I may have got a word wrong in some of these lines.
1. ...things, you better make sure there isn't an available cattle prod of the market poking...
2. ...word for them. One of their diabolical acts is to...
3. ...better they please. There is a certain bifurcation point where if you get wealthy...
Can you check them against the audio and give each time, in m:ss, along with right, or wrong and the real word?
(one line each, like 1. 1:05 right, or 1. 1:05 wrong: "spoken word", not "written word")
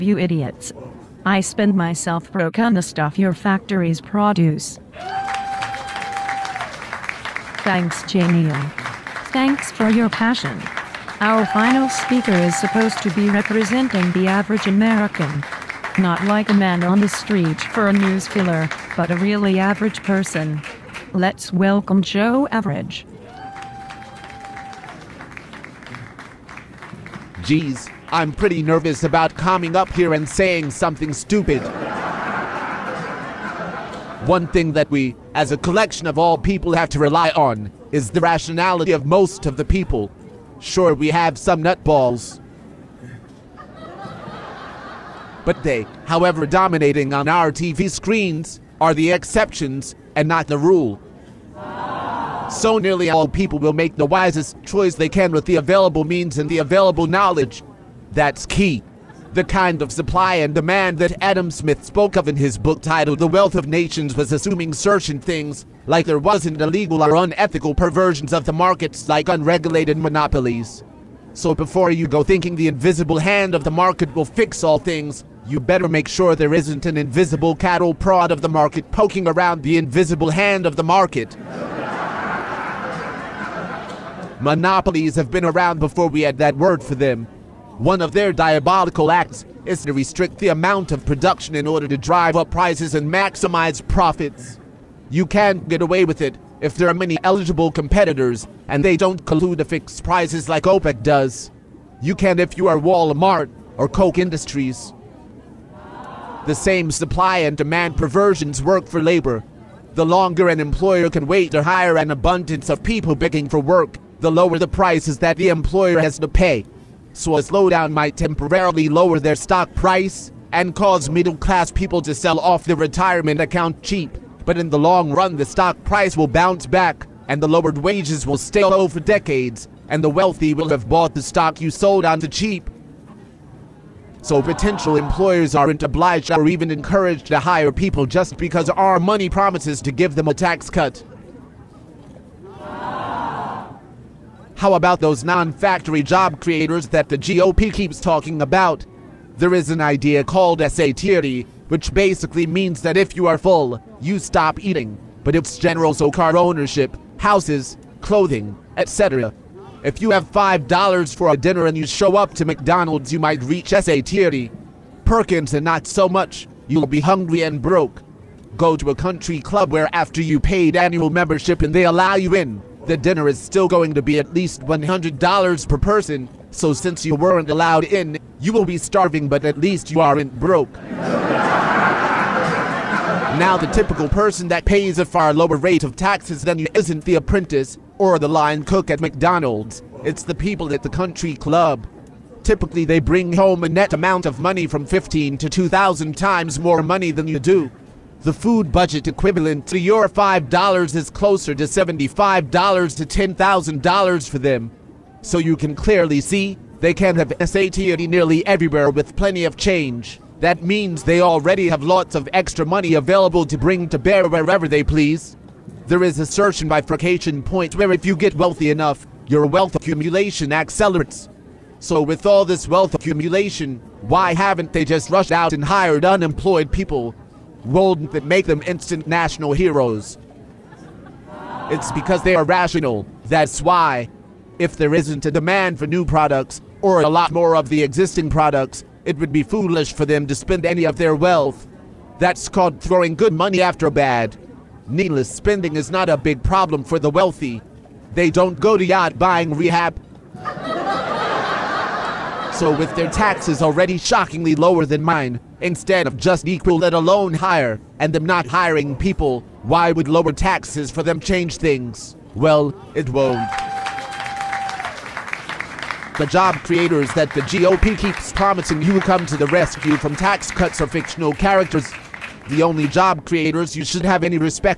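1. 1:14 wrong: "invisible", not "available"
2. 1:26 right
3. 3:34 wrong: "wherever", not "better".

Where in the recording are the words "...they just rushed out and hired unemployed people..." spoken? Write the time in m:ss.
3:44.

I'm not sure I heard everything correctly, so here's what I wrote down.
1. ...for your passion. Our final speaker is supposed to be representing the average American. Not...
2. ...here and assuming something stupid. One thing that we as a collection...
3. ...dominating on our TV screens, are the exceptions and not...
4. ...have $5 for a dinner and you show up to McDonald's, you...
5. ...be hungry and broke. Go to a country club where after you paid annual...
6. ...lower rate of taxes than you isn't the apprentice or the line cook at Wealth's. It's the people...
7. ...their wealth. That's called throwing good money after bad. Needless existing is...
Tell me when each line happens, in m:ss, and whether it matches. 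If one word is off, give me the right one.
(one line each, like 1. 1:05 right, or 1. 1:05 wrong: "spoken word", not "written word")
1. 0:09 right
2. 0:29 wrong: "saying", not "assuming"
3. 0:46 right
4. 2:40 right
5. 2:46 right
6. 3:05 wrong: "McDonald", not "Wealth"
7. 4:00 wrong: "spending", not "existing".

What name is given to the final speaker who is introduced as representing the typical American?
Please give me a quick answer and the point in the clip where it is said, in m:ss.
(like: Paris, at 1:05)
Joe Average, at 0:22.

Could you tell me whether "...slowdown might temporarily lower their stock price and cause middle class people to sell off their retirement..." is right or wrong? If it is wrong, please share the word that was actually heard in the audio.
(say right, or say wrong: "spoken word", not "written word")
right.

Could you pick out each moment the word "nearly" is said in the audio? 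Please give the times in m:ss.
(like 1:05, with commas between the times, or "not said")
0:52, 3:28.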